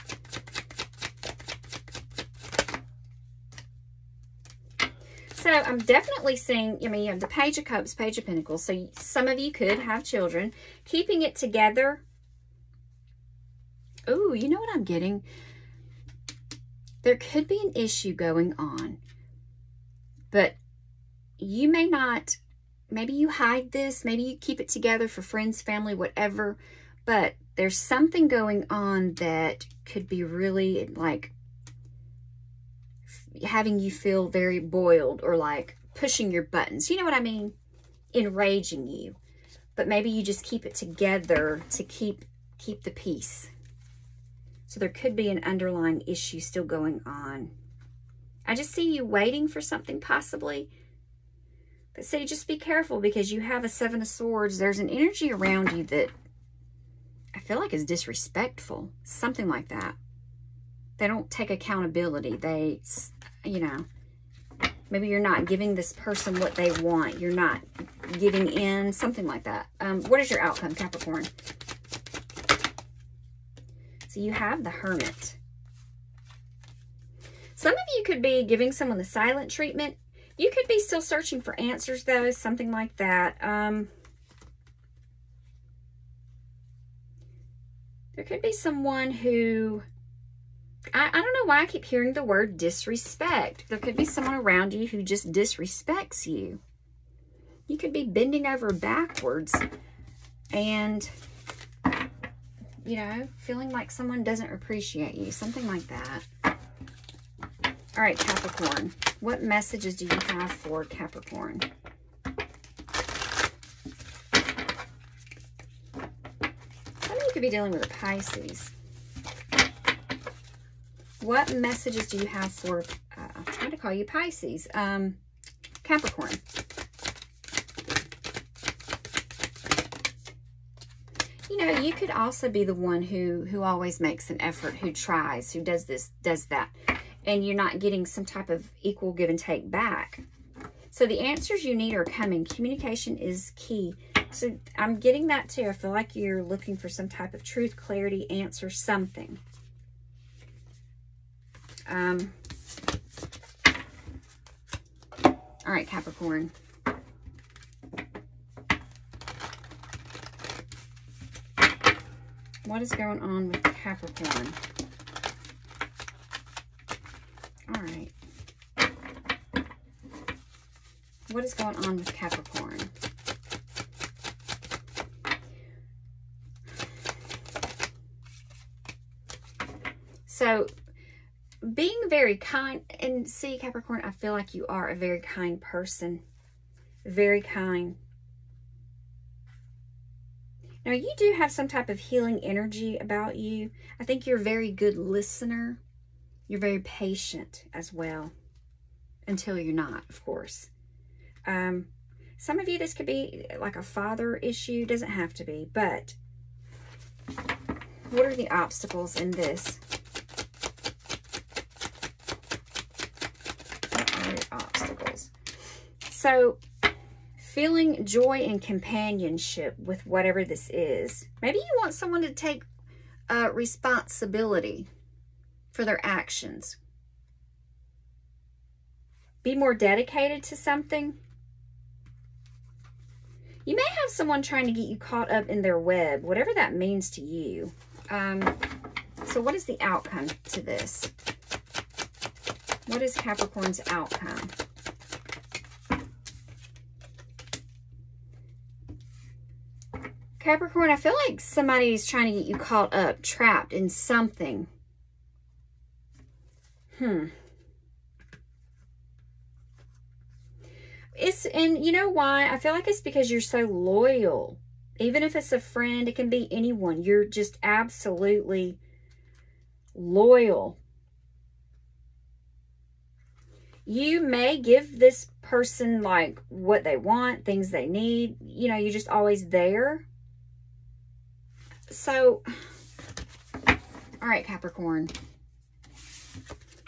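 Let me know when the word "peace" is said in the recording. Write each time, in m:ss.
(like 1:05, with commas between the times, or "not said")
0:42.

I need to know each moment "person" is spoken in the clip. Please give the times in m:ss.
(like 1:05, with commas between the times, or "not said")
1:05, 3:05, 4:35.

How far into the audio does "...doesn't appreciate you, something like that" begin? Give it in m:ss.
1:44.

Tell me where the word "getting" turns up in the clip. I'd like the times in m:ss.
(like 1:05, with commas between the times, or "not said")
0:14, 2:17, 2:24.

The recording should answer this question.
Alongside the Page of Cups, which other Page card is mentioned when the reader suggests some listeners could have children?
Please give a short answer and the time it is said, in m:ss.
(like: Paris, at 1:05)
Page of Pentacles, at 0:07.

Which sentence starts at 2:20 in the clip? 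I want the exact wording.
So the answers you need are coming.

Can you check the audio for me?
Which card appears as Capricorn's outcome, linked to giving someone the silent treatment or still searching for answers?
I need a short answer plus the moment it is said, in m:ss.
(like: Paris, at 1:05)
The Hermit, at 1:14.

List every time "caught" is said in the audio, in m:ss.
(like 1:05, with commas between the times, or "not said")
3:54, 4:12.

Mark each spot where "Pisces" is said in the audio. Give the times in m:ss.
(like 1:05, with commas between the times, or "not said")
1:57, 2:04.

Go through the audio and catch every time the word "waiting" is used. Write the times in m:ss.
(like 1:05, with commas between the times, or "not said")
0:49.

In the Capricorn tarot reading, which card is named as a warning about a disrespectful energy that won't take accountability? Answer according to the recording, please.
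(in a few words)
Seven of Swords.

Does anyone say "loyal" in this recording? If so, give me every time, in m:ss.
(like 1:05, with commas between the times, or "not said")
4:23, 4:29.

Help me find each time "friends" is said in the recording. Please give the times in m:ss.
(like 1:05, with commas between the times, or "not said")
0:25, 4:25.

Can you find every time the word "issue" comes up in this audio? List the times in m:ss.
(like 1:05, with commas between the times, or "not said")
0:17, 0:46, 3:24.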